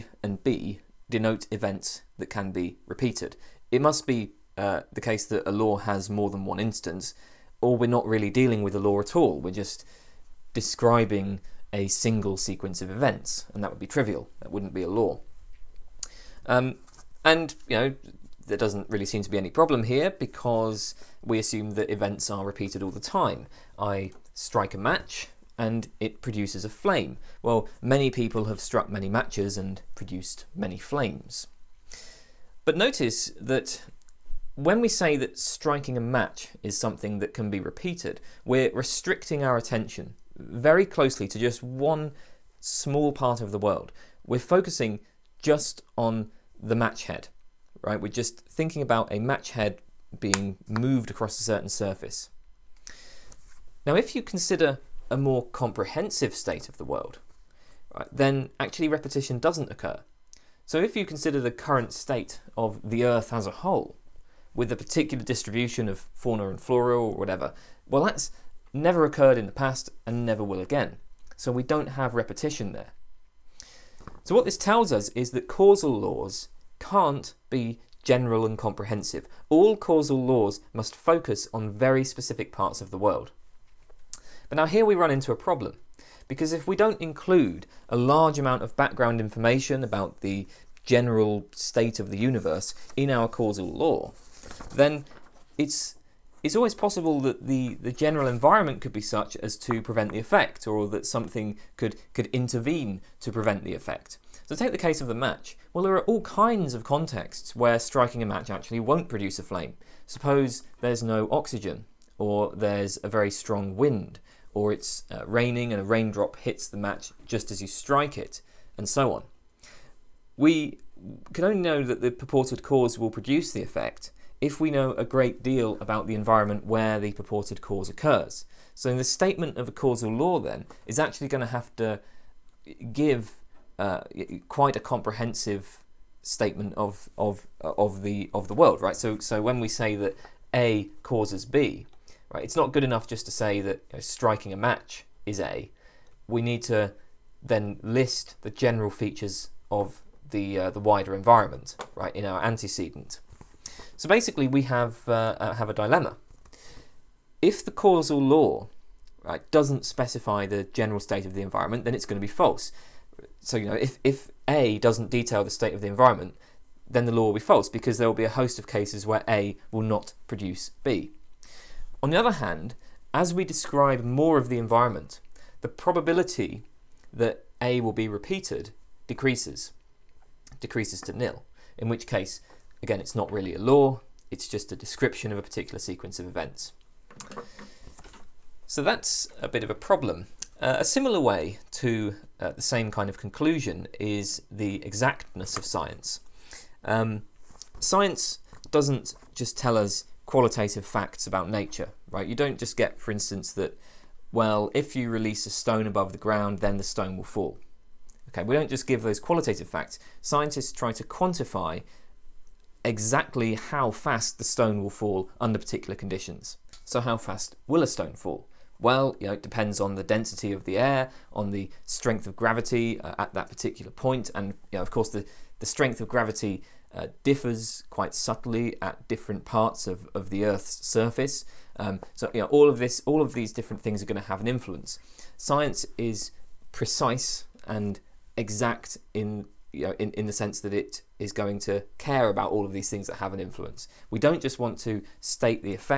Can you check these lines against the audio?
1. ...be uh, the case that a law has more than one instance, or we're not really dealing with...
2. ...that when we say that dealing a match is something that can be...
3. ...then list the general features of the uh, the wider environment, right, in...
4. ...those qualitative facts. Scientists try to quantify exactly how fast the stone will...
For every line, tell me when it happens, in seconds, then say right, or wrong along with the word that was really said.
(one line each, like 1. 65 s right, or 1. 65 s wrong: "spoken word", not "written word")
1. 4 s right
2. 33 s wrong: "striking", not "dealing"
3. 147 s right
4. 209 s right.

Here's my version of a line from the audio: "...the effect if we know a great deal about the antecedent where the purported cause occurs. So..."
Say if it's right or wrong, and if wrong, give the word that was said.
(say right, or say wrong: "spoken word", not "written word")
wrong: "environment", not "antecedent".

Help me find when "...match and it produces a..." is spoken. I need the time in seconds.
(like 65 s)
24 s.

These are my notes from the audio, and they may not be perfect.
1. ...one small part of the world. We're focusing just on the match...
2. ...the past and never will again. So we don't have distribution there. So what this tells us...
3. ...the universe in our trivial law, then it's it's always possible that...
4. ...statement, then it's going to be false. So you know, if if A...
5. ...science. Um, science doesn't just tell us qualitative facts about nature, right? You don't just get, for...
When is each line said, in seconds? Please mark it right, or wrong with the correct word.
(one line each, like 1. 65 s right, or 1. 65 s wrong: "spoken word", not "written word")
1. 41 s right
2. 69 s wrong: "repetition", not "distribution"
3. 92 s wrong: "causal", not "trivial"
4. 161 s wrong: "environment", not "statement"
5. 195 s right.